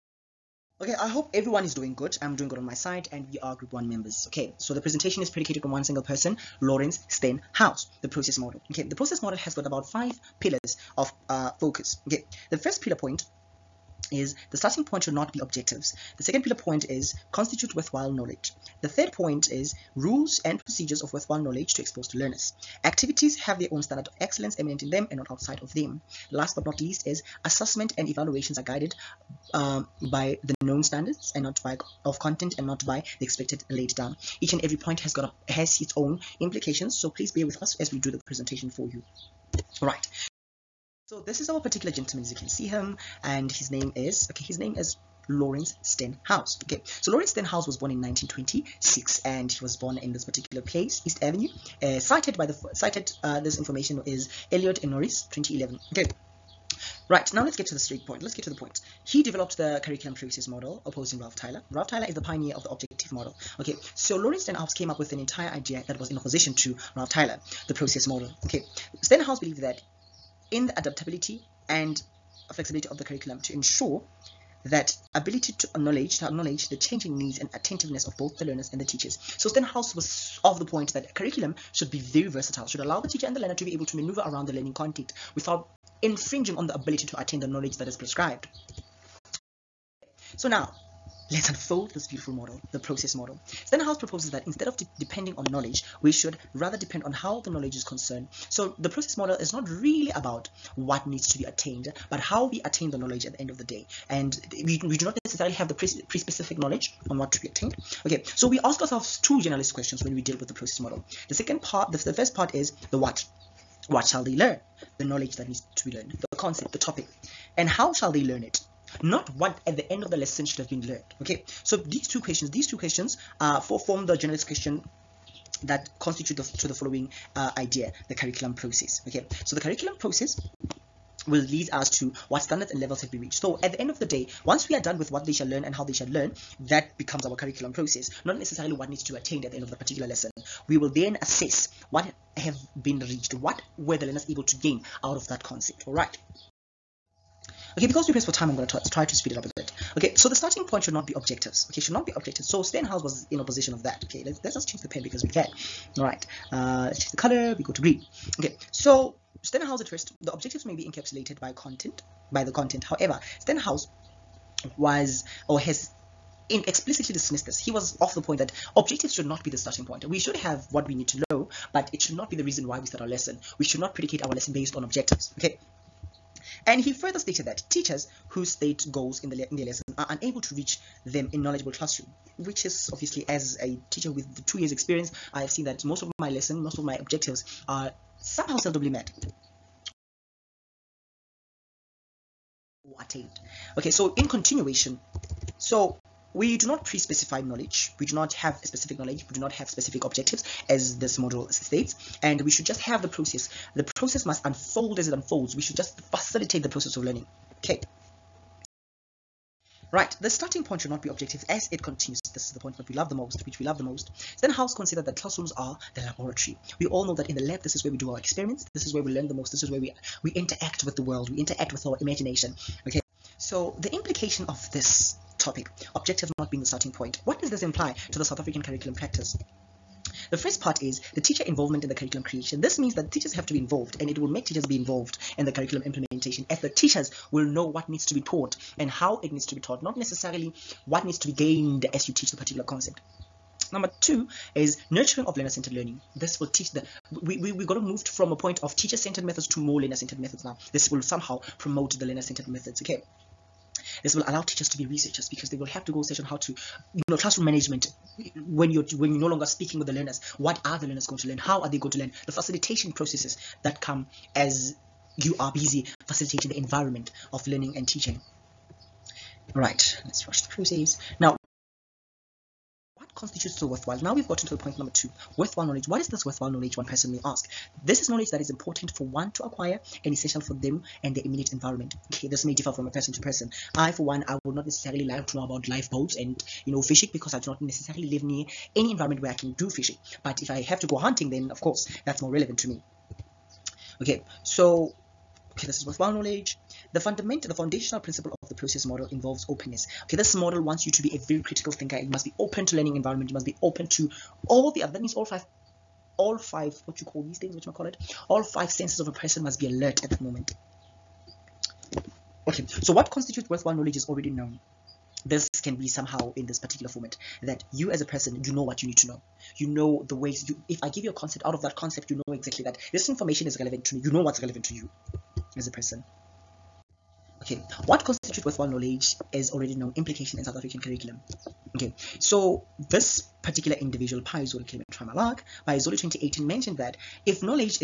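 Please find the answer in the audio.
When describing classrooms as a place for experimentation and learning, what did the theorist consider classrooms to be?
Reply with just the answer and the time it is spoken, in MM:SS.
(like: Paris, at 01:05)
the laboratory, at 03:35.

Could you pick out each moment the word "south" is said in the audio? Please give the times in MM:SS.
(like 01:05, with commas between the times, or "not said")
03:48, 05:30.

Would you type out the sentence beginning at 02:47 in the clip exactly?
He was off the point that objectives should not be the starting point.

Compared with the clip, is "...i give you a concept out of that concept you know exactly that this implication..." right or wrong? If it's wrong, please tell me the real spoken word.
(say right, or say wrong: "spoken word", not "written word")
wrong: "information", not "implication".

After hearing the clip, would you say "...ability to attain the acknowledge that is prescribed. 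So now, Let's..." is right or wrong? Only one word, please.
wrong.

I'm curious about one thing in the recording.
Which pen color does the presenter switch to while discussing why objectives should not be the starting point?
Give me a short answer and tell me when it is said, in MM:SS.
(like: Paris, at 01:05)
green, at 02:37.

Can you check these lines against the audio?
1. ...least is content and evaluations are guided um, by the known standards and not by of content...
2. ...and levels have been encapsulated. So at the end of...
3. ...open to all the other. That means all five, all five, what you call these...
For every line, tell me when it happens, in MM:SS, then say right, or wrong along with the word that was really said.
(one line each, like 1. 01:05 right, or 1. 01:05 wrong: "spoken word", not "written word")
1. 00:26 wrong: "assessment", not "content"
2. 02:12 wrong: "reached", not "encapsulated"
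3. 05:03 right.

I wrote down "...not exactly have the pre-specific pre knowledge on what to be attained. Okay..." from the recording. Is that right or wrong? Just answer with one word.
wrong.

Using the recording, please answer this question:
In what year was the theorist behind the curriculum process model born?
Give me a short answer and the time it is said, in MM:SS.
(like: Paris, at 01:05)
1926, at 00:48.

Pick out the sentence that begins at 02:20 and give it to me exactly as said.
We will then assess what have been reached, what were the learners able to gain out of that concept, all right?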